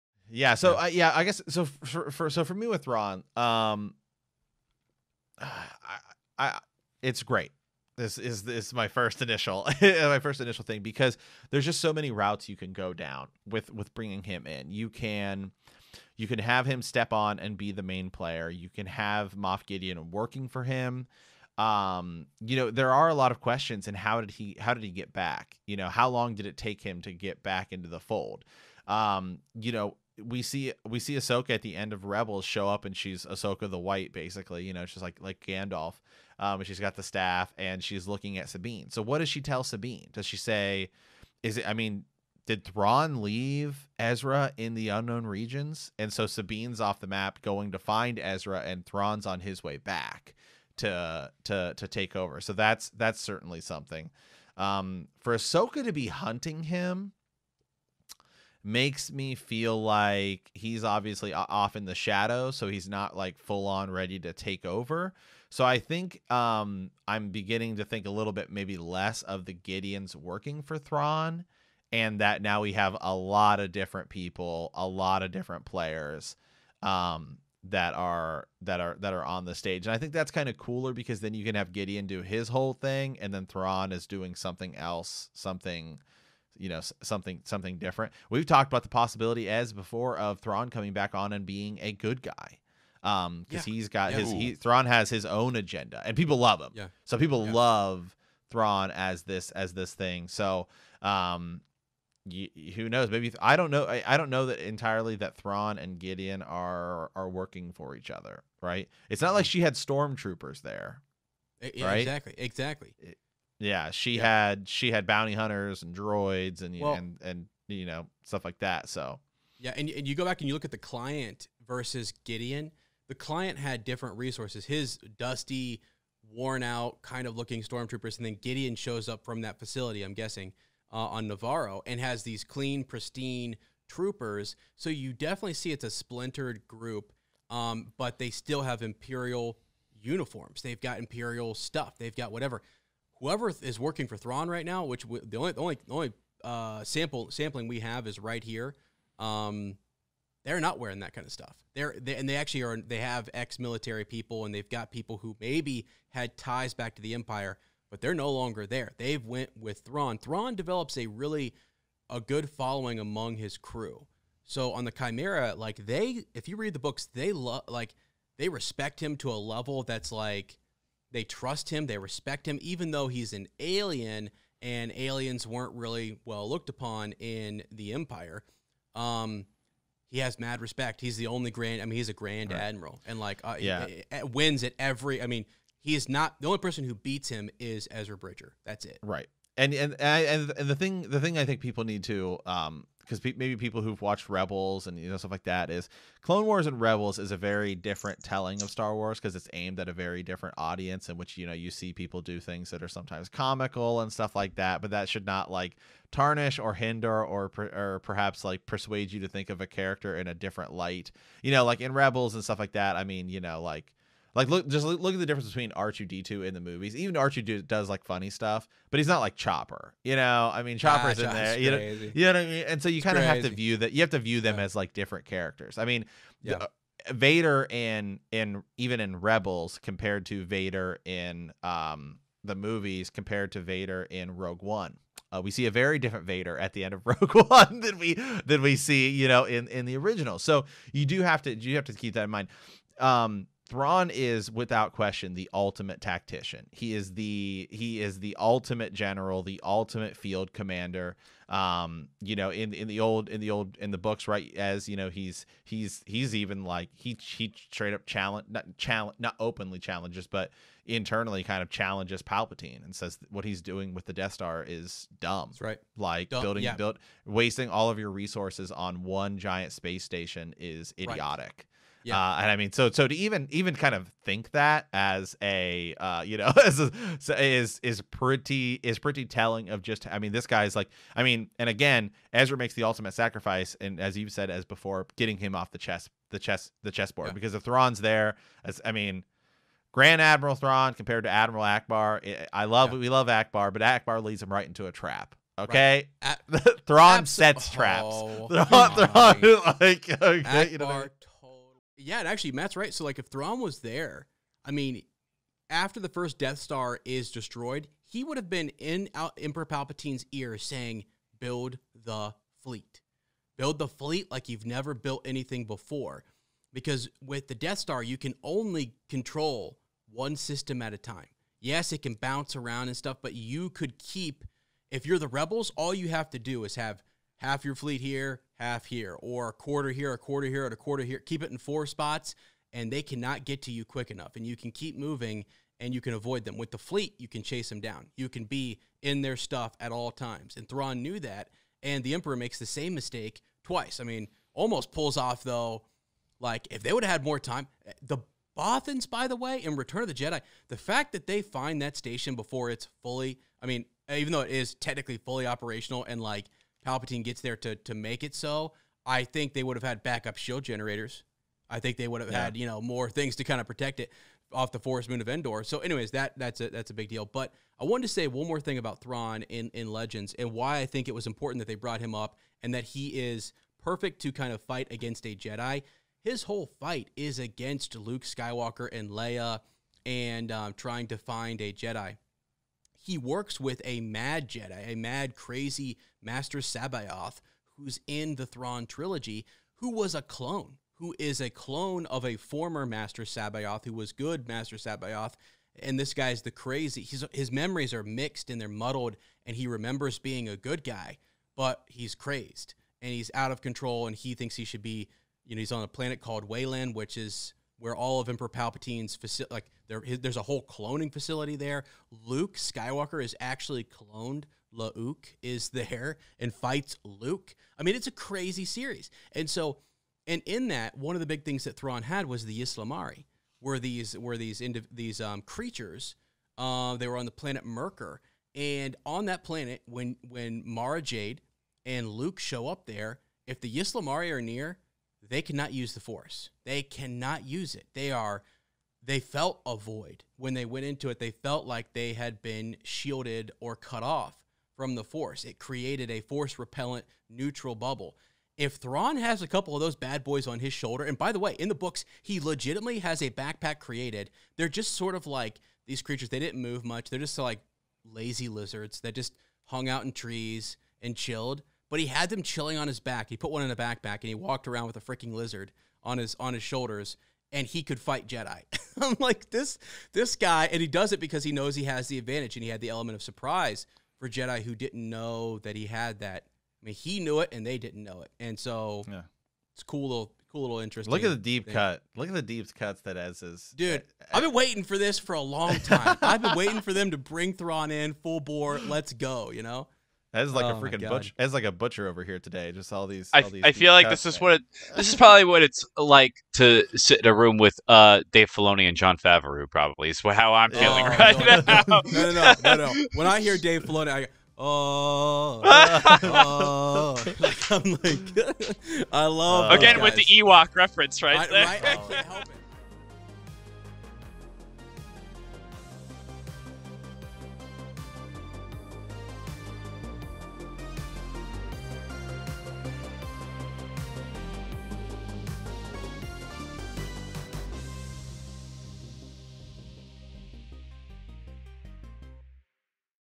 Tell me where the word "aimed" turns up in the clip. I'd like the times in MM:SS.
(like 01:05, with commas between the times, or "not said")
03:19.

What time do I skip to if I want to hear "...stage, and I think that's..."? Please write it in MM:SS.
01:19.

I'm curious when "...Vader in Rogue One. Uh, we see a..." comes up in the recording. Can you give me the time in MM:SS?
03:53.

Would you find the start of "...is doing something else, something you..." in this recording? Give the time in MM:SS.
01:23.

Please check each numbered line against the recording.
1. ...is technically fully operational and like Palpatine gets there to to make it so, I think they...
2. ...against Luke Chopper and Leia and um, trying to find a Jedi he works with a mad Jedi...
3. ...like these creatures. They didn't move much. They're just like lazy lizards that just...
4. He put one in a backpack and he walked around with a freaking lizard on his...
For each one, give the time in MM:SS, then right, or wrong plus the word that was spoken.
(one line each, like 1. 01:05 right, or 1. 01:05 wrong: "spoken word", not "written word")
1. 05:54 right
2. 06:17 wrong: "Skywalker", not "Chopper"
3. 07:35 right
4. 07:43 right.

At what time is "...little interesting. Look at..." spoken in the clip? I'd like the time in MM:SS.
08:00.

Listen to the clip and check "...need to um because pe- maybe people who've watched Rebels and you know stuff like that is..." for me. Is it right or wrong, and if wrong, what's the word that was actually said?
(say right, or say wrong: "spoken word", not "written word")
right.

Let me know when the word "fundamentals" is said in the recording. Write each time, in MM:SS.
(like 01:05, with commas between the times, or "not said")
not said.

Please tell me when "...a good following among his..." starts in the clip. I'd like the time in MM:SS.
02:42.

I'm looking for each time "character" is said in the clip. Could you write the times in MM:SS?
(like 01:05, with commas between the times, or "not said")
03:29, 03:45.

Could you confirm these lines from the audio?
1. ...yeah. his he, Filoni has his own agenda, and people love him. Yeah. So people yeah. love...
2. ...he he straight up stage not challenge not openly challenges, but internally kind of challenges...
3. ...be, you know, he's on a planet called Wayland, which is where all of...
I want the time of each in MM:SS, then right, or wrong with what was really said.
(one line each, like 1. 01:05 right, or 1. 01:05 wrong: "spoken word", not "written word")
1. 01:34 wrong: "Thrawn", not "Filoni"
2. 04:16 wrong: "challenge", not "stage"
3. 06:44 right.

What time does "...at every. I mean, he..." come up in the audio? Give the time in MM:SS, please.
03:04.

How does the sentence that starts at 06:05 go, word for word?
So, anyways, that that's a that's a big deal.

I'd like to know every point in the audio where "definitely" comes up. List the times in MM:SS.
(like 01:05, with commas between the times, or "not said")
02:15.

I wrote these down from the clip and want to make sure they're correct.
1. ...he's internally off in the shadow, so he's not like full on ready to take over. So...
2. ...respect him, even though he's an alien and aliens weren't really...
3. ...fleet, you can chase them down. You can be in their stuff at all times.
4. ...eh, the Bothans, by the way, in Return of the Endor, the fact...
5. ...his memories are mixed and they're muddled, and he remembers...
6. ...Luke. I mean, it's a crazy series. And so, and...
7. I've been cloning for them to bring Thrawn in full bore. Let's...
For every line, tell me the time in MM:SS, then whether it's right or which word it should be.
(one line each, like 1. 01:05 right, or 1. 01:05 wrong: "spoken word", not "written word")
1. 01:00 wrong: "obviously", not "internally"
2. 02:51 right
3. 05:36 right
4. 05:47 wrong: "Jedi", not "Endor"
5. 06:37 right
6. 06:57 right
7. 08:06 wrong: "waiting", not "cloning".